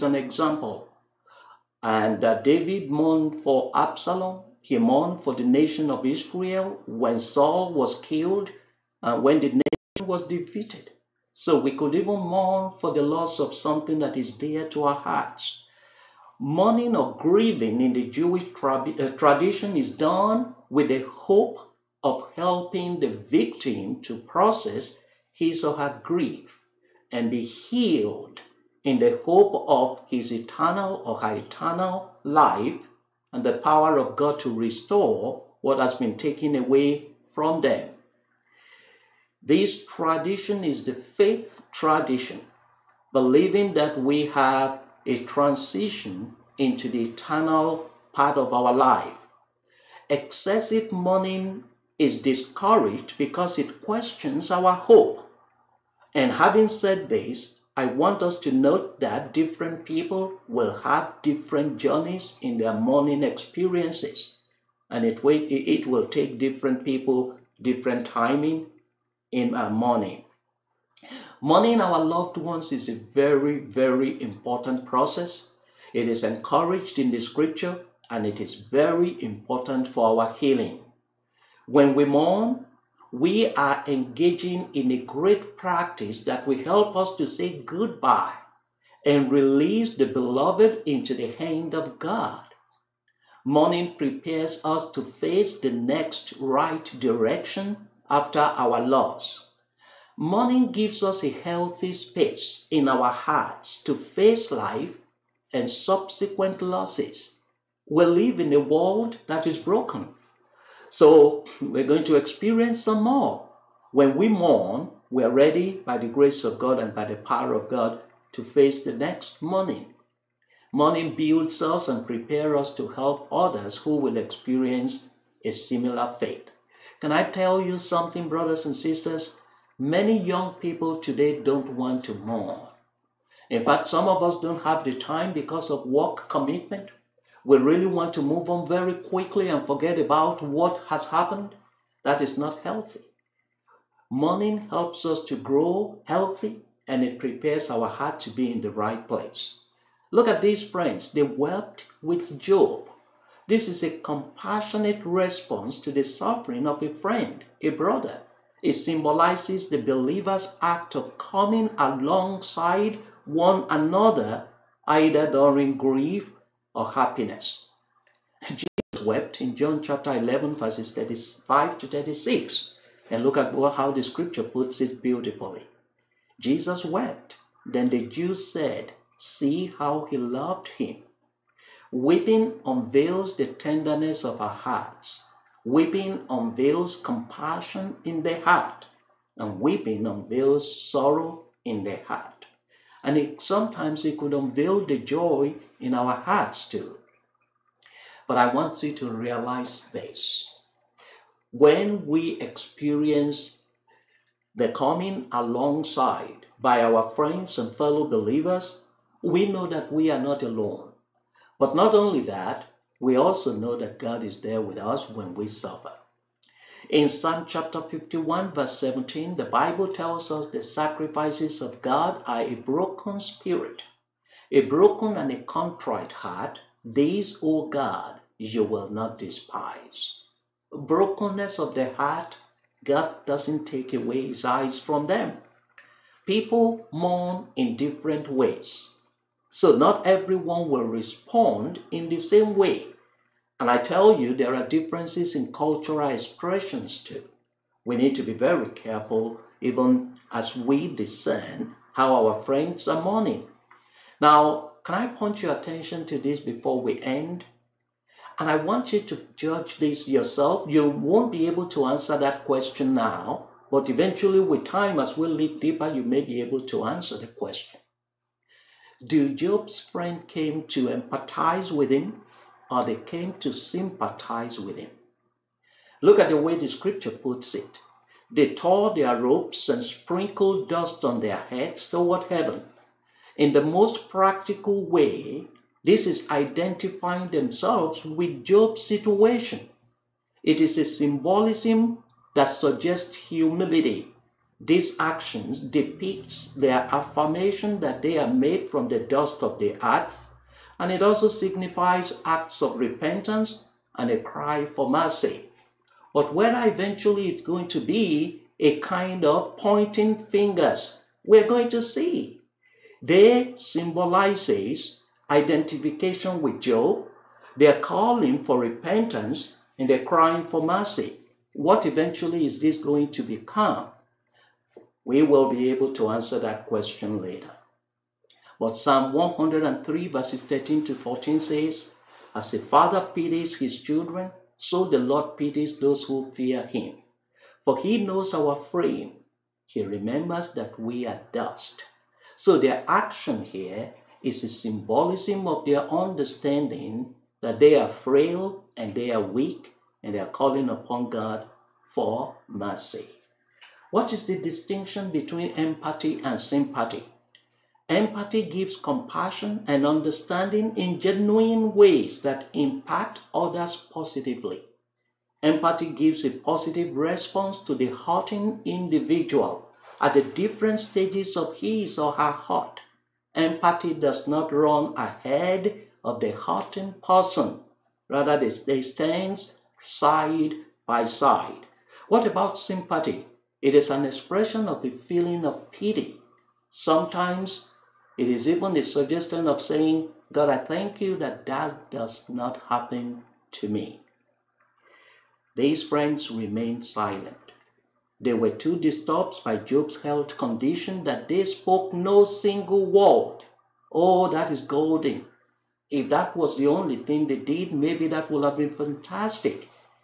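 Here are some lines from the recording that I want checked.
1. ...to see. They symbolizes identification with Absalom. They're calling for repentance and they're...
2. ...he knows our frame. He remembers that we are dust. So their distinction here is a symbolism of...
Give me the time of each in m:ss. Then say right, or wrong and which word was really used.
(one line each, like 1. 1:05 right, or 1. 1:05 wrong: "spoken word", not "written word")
1. 5:11 wrong: "Job", not "Absalom"
2. 5:37 wrong: "action", not "distinction".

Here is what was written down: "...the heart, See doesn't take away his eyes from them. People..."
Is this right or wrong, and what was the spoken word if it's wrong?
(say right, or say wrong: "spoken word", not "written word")
wrong: "God", not "See".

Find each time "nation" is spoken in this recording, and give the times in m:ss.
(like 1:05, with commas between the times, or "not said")
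0:05, 0:09.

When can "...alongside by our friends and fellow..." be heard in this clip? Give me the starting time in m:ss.
3:25.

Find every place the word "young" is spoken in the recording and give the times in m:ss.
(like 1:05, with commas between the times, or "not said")
2:10.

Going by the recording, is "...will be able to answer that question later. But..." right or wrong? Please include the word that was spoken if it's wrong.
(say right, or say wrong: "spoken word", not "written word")
right.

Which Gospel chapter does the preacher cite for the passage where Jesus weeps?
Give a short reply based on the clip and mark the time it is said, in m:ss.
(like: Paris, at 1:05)
John chapter 11, at 2:49.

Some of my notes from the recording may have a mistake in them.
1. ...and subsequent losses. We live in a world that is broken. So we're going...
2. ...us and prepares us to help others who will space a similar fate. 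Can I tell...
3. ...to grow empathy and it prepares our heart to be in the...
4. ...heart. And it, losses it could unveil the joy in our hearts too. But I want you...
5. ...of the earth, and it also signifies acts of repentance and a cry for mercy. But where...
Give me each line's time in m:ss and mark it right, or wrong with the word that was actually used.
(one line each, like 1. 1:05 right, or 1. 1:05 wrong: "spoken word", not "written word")
1. 1:45 right
2. 2:01 wrong: "experience", not "space"
3. 2:25 wrong: "healthy", not "empathy"
4. 3:11 wrong: "sometimes", not "losses"
5. 4:59 right.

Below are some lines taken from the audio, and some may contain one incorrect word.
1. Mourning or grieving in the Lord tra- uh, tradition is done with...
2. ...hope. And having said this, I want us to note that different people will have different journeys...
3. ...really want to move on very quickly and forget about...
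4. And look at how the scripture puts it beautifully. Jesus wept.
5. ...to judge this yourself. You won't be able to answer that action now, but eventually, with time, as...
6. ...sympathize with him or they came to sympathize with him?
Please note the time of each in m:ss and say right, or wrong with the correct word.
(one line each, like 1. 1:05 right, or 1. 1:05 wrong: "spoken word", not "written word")
1. 0:16 wrong: "Jewish", not "Lord"
2. 0:54 right
3. 2:17 right
4. 2:53 right
5. 4:18 wrong: "question", not "action"
6. 4:30 wrong: "empathize", not "sympathize".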